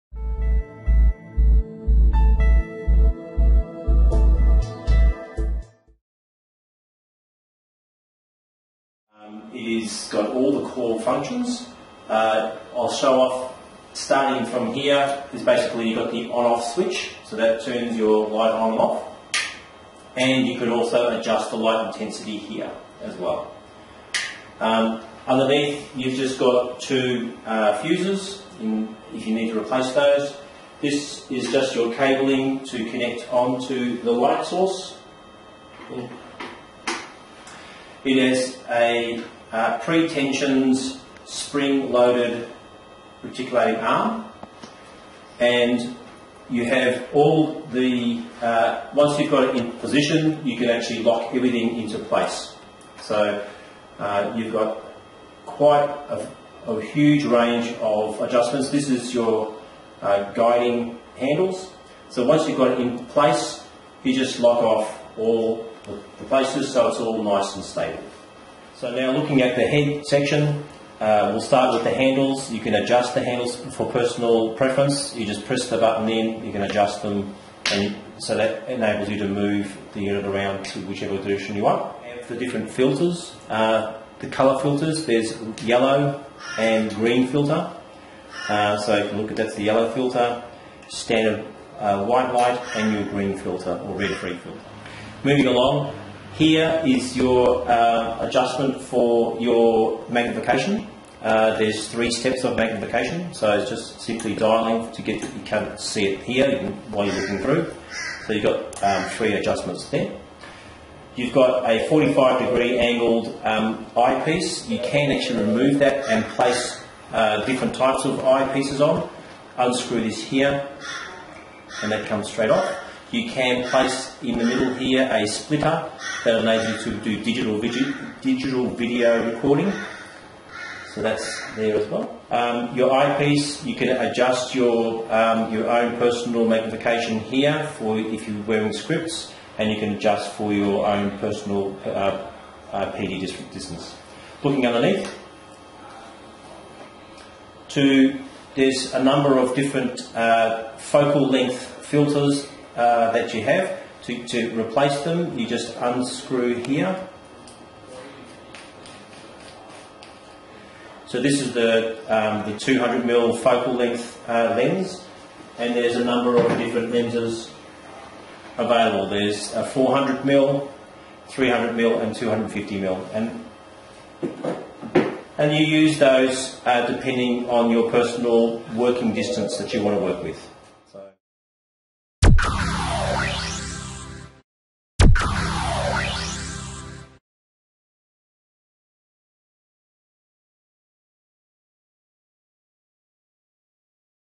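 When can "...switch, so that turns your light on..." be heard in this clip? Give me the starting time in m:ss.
0:16.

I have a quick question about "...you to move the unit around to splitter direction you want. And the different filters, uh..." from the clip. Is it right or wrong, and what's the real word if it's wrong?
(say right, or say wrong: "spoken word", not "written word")
wrong: "whichever", not "splitter".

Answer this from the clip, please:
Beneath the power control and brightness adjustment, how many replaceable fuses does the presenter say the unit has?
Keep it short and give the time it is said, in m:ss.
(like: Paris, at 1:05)
2, at 0:26.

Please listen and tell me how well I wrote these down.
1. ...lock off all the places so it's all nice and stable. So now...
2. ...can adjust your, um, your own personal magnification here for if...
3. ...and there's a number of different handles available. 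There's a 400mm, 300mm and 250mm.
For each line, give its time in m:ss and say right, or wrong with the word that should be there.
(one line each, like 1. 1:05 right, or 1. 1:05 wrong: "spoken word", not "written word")
1. 1:04 right
2. 2:13 right
3. 2:45 wrong: "lenses", not "handles".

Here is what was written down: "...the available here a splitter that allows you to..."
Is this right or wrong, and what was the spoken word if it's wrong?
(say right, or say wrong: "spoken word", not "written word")
wrong: "middle", not "available".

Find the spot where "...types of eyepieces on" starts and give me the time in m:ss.
1:57.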